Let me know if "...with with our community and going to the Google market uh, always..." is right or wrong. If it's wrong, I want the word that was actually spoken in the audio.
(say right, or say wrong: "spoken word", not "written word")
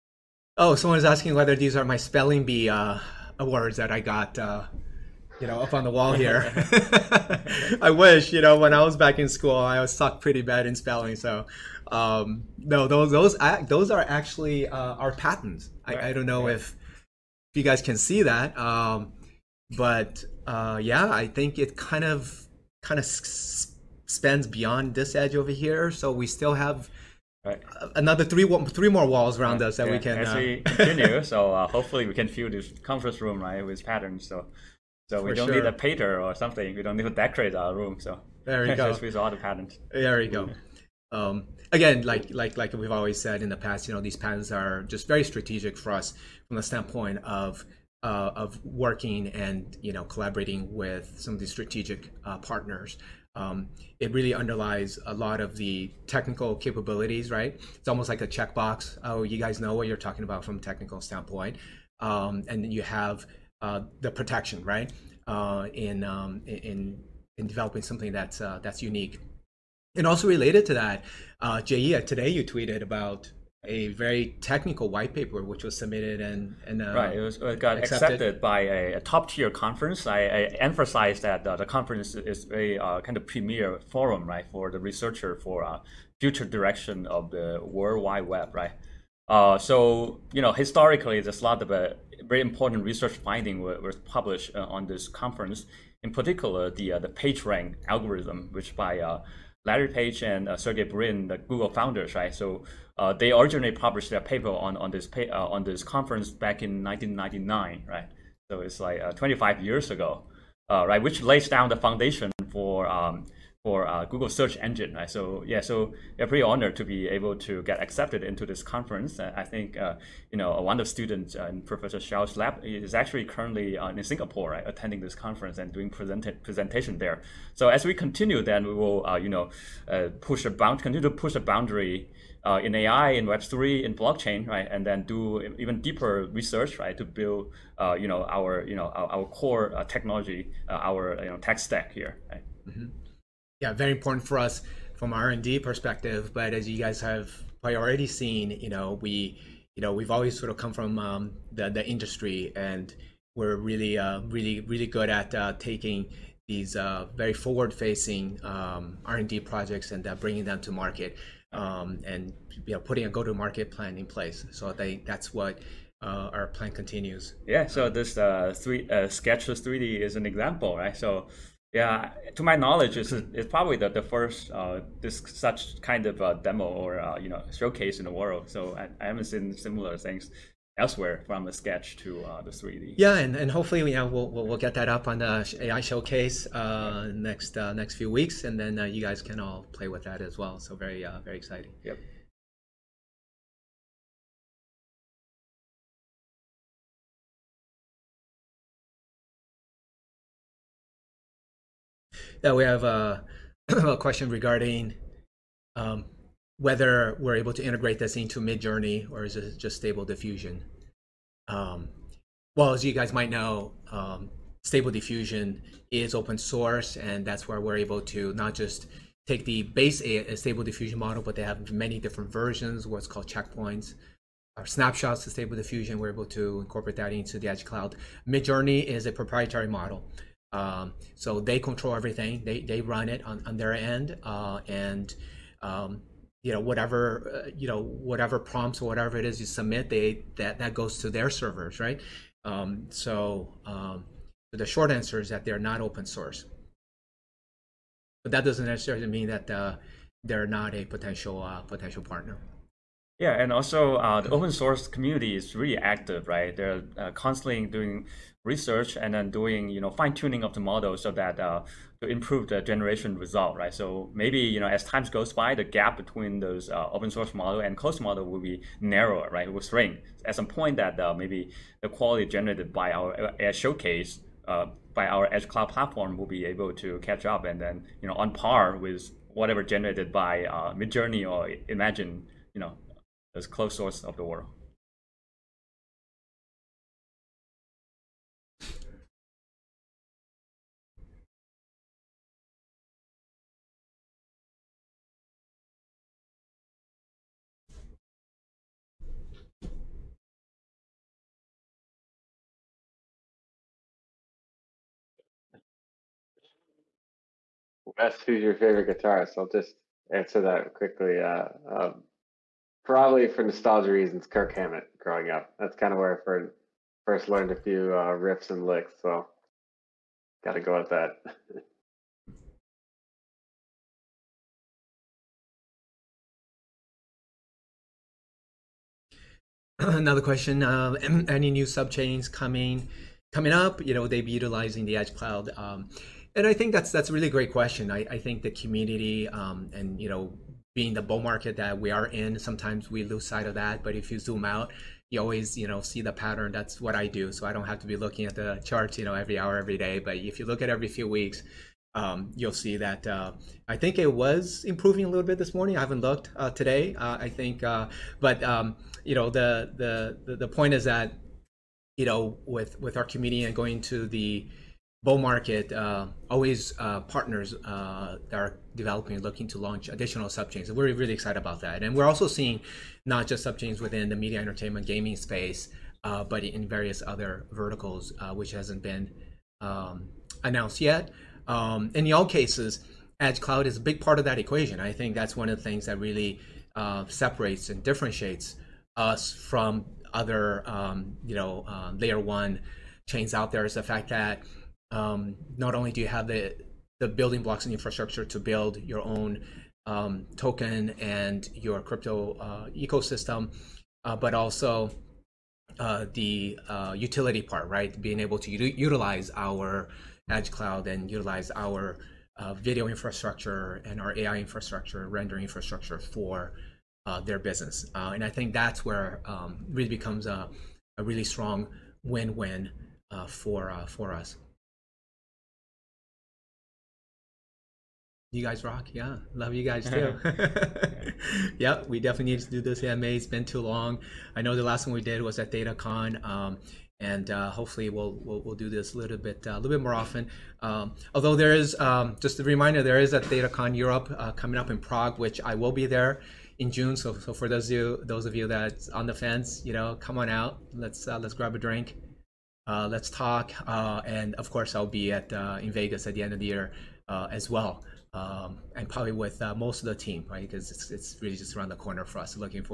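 wrong: "Bull", not "Google".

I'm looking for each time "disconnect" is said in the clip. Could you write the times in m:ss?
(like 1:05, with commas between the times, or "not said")
not said.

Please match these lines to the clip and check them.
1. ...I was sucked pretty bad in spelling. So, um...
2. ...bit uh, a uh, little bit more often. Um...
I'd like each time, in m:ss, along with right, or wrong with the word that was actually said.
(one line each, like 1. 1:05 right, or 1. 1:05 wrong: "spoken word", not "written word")
1. 0:09 right
2. 7:19 right.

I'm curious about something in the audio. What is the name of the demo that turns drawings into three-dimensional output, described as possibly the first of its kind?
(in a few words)
Sketchless 3D.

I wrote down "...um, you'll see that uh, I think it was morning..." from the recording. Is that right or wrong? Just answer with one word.
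wrong.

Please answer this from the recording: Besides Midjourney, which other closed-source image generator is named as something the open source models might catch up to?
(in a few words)
Imagen.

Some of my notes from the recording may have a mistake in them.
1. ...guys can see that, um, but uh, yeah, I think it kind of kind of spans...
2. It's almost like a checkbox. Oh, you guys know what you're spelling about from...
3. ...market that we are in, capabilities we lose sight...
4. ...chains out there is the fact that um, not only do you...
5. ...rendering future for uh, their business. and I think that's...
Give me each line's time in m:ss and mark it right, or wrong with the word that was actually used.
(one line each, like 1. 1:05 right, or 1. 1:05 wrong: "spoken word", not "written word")
1. 0:17 right
2. 0:57 wrong: "talking", not "spelling"
3. 5:41 wrong: "sometimes", not "capabilities"
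4. 6:33 right
5. 6:55 wrong: "infrastructure", not "future".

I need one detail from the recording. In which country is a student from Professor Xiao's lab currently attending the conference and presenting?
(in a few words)
Singapore.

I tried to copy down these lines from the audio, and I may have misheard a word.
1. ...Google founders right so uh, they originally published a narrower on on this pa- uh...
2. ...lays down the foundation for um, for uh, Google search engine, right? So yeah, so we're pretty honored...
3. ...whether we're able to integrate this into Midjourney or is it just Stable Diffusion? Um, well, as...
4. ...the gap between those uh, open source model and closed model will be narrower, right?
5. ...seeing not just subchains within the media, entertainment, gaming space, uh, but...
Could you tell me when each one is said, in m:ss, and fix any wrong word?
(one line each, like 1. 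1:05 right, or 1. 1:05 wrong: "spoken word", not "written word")
1. 1:41 wrong: "paper", not "narrower"
2. 1:51 right
3. 3:26 right
4. 4:25 right
5. 6:12 right.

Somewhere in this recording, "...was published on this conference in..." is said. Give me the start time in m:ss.
1:33.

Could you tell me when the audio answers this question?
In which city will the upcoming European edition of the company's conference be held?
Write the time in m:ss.
7:24.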